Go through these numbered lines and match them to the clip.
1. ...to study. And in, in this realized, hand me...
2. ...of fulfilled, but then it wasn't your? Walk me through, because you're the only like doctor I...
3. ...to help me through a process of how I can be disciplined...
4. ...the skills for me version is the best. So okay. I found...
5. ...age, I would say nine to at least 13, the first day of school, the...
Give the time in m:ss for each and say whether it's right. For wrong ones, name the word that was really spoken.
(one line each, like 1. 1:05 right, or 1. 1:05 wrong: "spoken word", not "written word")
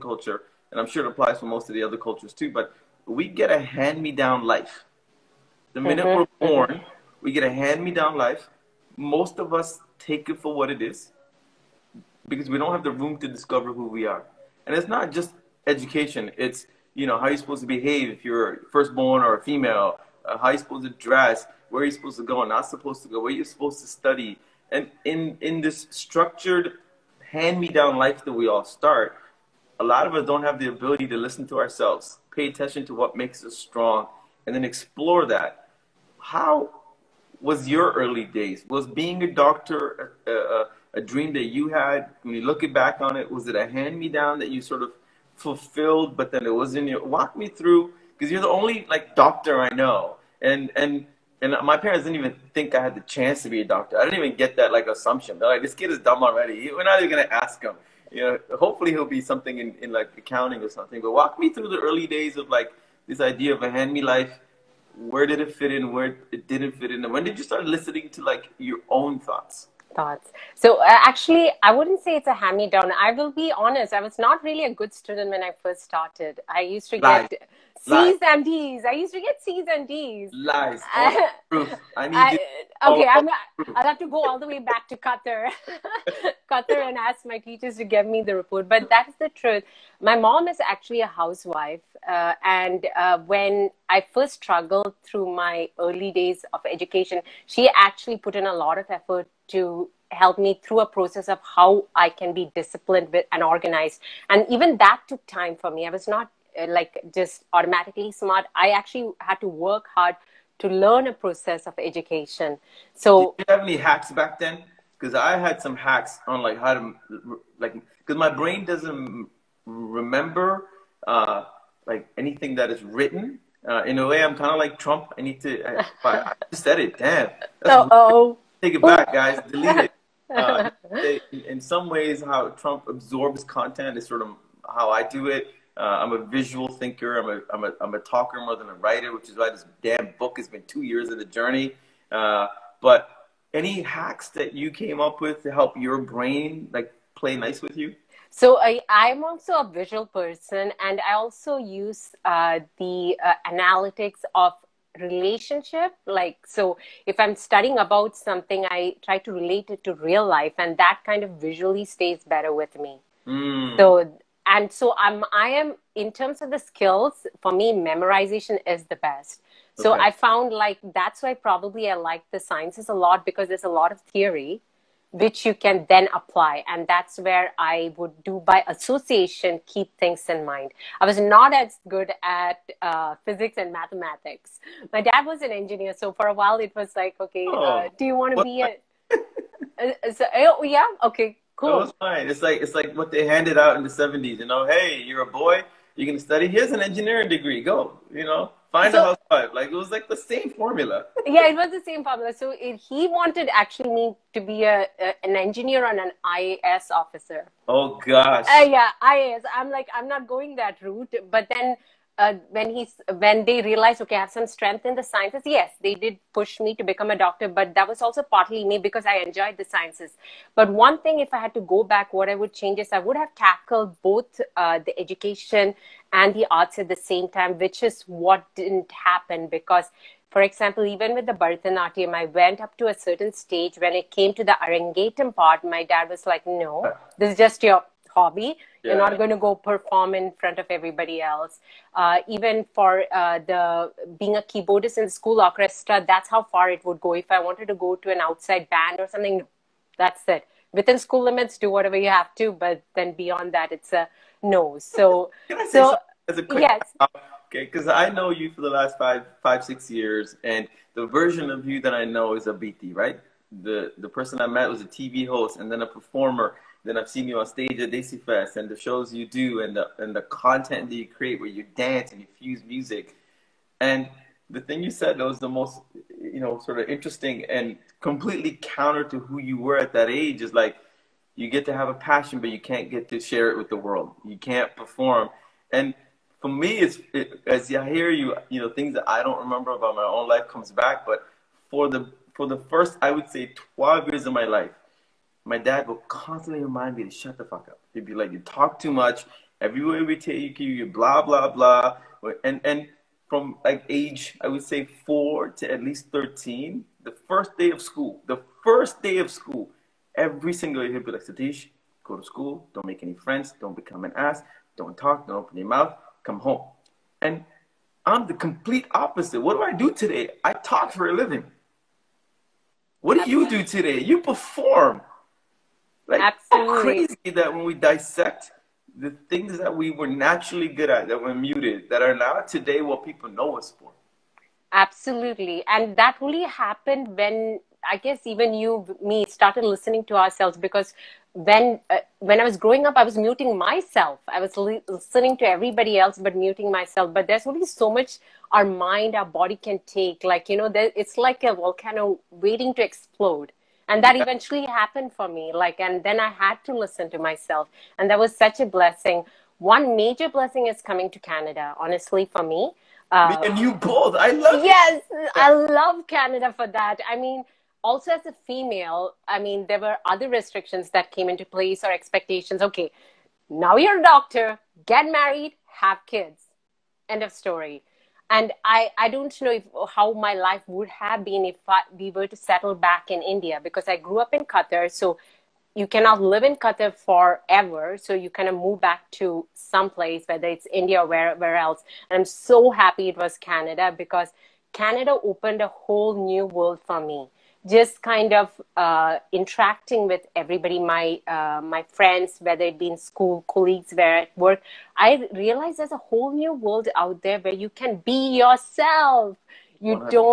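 1. 0:23 wrong: "structured", not "realized"
2. 0:44 right
3. 1:39 right
4. 2:46 wrong: "memorization", not "version"
5. 5:03 wrong: "four", not "nine".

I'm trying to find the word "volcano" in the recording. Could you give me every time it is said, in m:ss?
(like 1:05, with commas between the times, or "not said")
5:51.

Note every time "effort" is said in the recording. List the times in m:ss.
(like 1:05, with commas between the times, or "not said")
1:38.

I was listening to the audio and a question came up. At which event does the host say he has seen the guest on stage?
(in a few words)
Desi Fest.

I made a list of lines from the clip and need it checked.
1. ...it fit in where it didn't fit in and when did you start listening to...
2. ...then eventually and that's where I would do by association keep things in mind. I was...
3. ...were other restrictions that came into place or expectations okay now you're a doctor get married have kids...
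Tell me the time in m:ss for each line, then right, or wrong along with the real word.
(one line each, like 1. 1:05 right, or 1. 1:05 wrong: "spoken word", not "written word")
1. 1:05 right
2. 2:55 wrong: "apply", not "eventually"
3. 6:09 right.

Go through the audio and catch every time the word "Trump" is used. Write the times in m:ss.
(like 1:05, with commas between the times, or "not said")
2:04, 2:12.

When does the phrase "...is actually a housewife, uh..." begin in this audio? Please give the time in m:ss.
1:30.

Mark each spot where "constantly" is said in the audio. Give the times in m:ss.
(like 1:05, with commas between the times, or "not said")
4:56.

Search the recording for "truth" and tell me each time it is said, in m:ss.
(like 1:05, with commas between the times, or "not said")
1:29.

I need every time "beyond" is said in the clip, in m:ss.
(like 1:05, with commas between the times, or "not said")
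4:13.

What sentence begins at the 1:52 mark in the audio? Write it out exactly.
So, did you have any hacks back then?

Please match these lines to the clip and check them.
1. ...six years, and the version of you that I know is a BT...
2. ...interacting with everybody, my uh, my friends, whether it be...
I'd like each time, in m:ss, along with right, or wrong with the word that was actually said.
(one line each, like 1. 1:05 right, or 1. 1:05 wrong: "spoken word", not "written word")
1. 4:19 right
2. 6:39 right.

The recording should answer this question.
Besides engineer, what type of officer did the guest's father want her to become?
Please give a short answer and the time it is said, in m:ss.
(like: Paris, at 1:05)
IAS officer, at 3:26.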